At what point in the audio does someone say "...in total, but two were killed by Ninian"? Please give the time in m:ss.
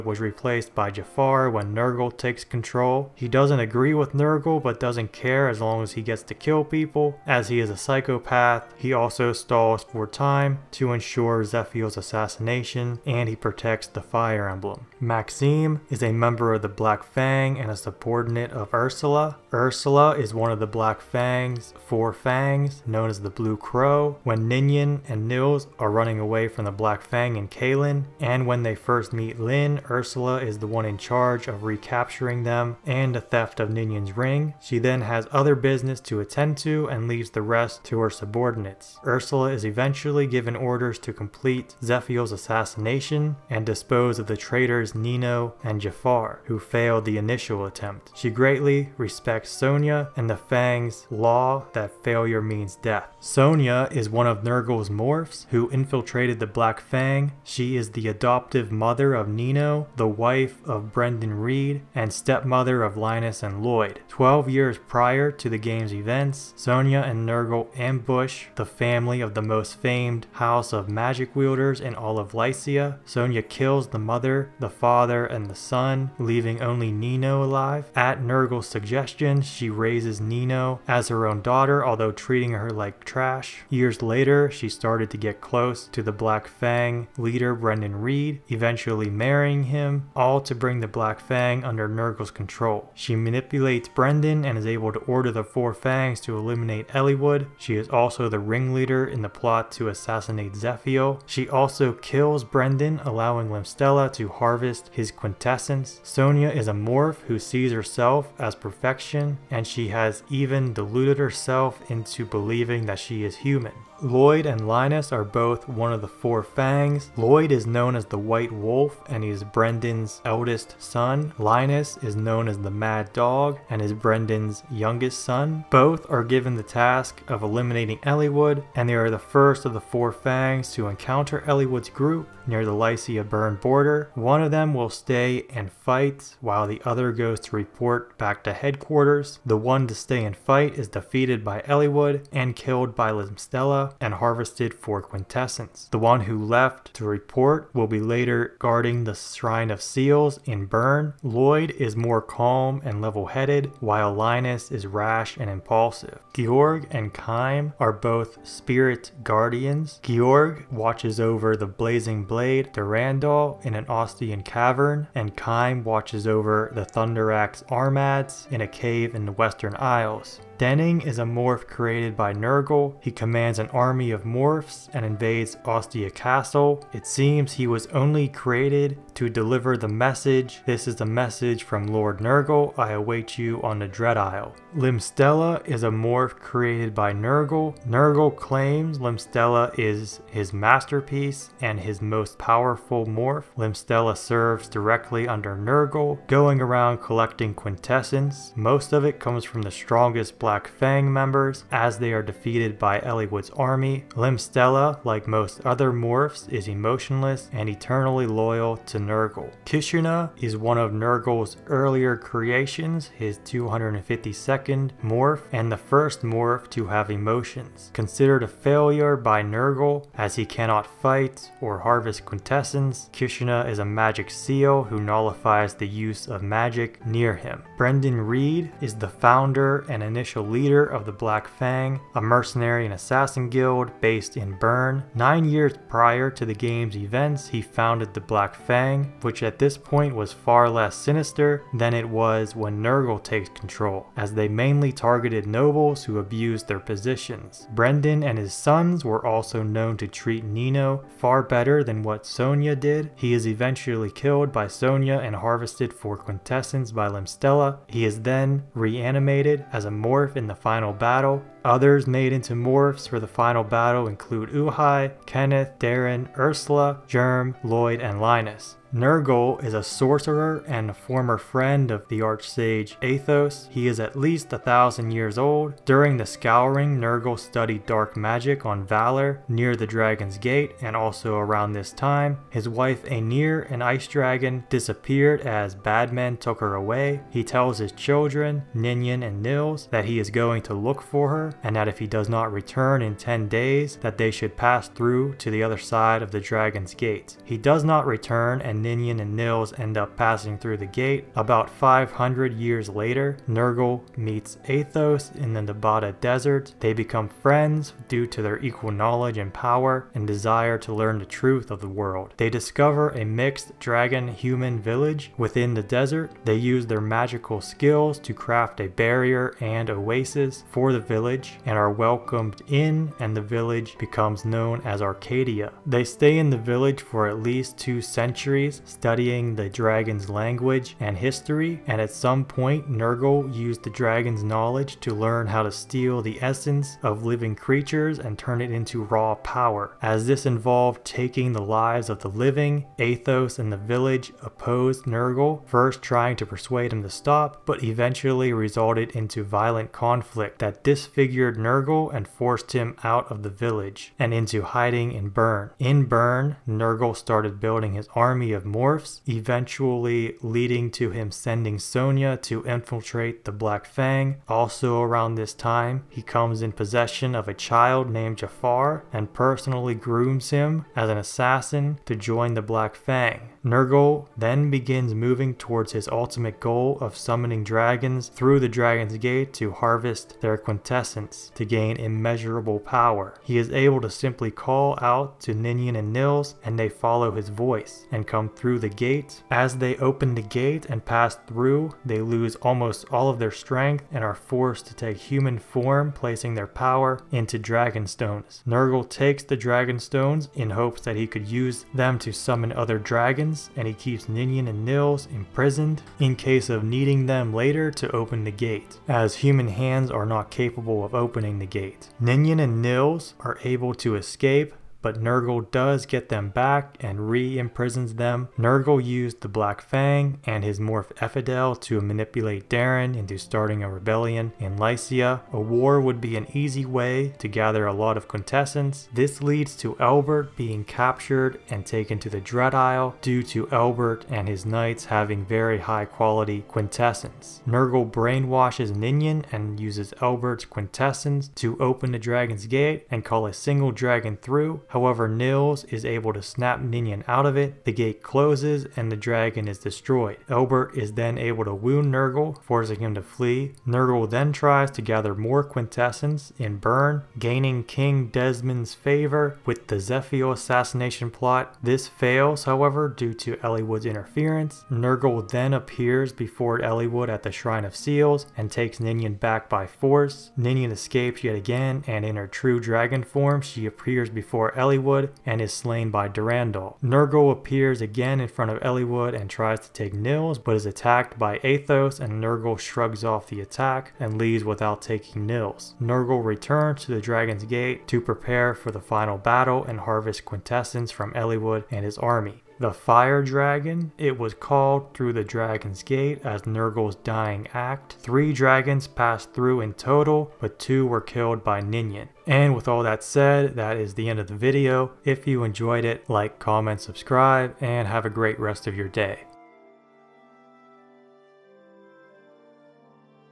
8:19.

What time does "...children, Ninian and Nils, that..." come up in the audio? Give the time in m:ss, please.
4:47.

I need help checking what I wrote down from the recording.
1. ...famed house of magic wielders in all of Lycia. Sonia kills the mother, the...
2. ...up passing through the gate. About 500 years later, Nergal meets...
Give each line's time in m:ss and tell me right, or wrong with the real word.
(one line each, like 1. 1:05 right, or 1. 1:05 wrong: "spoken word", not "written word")
1. 1:09 right
2. 4:59 right.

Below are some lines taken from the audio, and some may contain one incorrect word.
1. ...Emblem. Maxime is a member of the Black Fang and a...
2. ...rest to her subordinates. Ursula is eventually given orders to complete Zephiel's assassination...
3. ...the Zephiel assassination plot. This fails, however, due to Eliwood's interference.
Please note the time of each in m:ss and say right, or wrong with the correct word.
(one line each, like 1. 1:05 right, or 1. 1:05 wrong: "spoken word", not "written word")
1. 0:14 right
2. 0:37 right
3. 7:39 right.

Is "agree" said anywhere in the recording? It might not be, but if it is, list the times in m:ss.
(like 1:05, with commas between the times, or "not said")
0:03.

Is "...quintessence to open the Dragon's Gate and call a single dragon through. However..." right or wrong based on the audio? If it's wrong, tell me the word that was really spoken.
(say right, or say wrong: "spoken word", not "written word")
right.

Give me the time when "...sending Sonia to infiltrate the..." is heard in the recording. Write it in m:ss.
6:01.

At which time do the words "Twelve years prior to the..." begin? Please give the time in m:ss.
1:04.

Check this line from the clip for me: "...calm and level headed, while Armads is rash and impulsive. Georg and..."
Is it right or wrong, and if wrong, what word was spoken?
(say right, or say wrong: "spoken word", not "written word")
wrong: "Linus", not "Armads".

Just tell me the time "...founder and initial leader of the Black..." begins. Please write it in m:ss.
3:49.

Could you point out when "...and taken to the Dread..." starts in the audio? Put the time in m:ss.
7:11.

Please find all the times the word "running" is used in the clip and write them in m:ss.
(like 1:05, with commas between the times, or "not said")
0:25.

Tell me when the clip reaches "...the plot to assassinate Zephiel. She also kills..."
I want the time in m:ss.
1:39.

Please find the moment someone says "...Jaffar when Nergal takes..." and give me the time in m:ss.
0:00.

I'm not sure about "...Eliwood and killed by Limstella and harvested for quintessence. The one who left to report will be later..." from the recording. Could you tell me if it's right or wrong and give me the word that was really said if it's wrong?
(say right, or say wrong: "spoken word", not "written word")
right.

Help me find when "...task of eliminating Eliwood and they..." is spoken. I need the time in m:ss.
2:06.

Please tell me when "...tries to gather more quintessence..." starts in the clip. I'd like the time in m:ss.
7:34.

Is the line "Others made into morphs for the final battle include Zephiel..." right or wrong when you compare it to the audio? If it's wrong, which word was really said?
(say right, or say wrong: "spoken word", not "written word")
wrong: "Uhai", not "Zephiel".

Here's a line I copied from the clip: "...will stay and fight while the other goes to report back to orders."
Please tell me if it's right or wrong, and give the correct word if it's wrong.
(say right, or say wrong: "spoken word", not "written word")
wrong: "headquarters", not "orders".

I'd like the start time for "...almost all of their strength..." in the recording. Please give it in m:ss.
6:32.